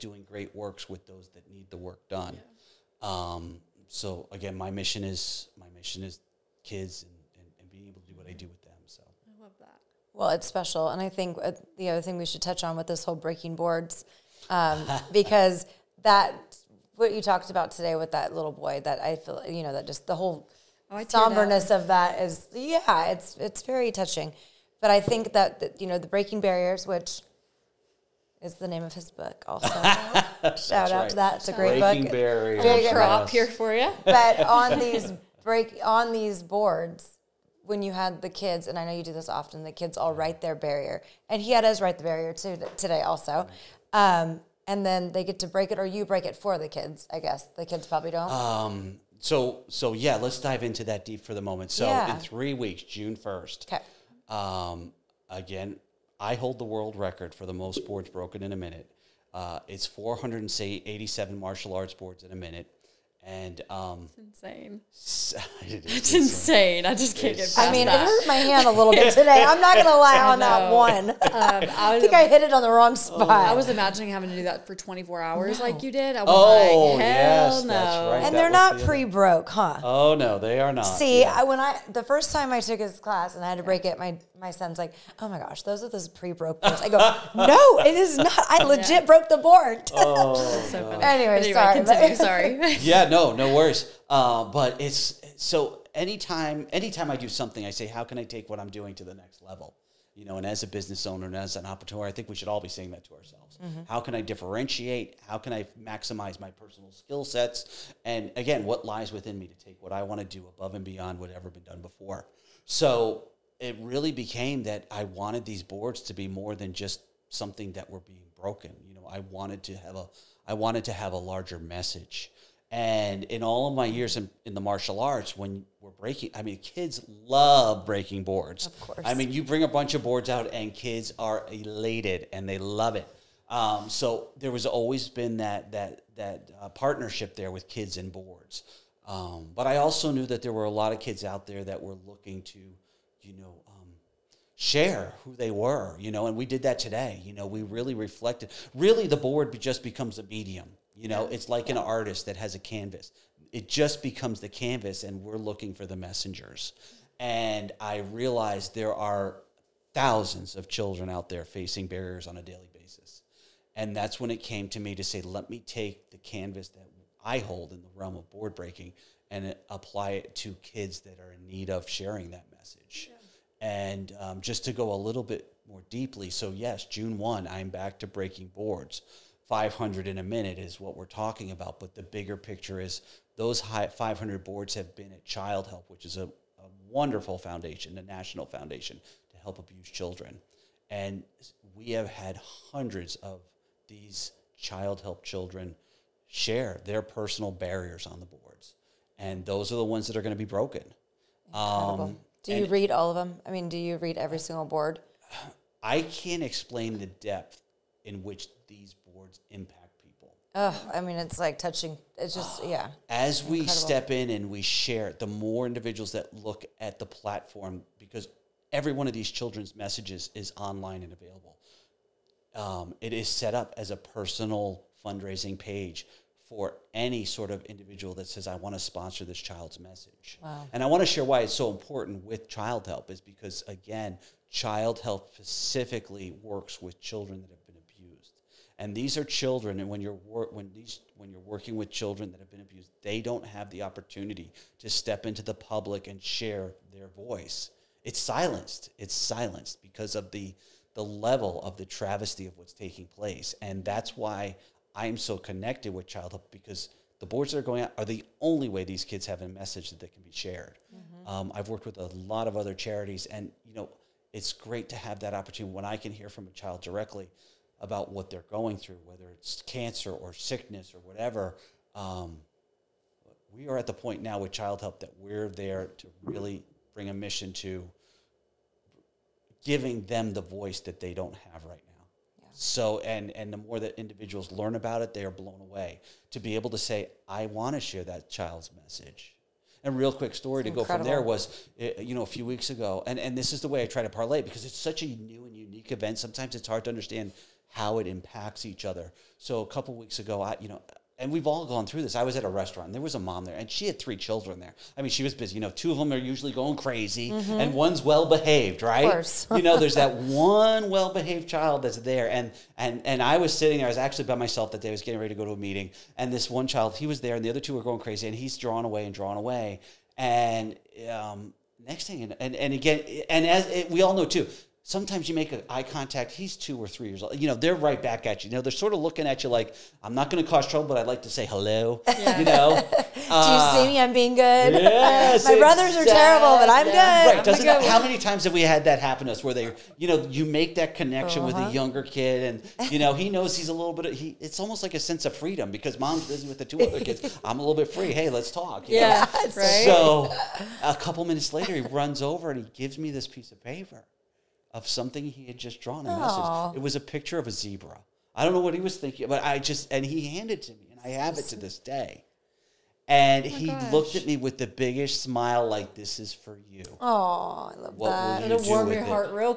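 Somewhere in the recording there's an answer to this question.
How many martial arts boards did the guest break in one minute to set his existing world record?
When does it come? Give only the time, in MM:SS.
00:59.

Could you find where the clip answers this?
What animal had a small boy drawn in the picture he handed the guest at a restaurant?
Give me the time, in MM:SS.
05:57.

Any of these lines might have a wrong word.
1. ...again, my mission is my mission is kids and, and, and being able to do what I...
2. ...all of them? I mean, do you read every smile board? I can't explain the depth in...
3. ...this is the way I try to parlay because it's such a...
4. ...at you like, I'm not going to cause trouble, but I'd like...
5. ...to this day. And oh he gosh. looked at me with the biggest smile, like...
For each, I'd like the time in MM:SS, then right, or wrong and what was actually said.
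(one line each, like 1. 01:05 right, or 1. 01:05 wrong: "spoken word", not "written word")
1. 00:04 right
2. 03:22 wrong: "single", not "smile"
3. 04:53 right
4. 05:29 right
5. 06:01 right.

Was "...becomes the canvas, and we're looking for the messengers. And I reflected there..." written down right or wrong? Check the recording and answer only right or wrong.
wrong.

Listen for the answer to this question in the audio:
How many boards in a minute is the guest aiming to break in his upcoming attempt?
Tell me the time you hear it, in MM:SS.
02:59.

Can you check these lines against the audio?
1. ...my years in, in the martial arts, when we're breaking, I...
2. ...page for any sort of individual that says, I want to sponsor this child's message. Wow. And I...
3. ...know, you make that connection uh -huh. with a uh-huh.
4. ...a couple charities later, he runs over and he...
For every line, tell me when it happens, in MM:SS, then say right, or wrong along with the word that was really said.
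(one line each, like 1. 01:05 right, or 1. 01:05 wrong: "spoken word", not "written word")
1. 02:03 right
2. 03:45 right
3. 05:40 right
4. 05:50 wrong: "minutes", not "charities".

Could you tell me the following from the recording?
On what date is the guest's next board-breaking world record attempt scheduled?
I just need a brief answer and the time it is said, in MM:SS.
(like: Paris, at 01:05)
June 1, at 00:52.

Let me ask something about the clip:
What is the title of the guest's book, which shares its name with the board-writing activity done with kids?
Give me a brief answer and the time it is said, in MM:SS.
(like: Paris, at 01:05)
Breaking Barriers, at 00:26.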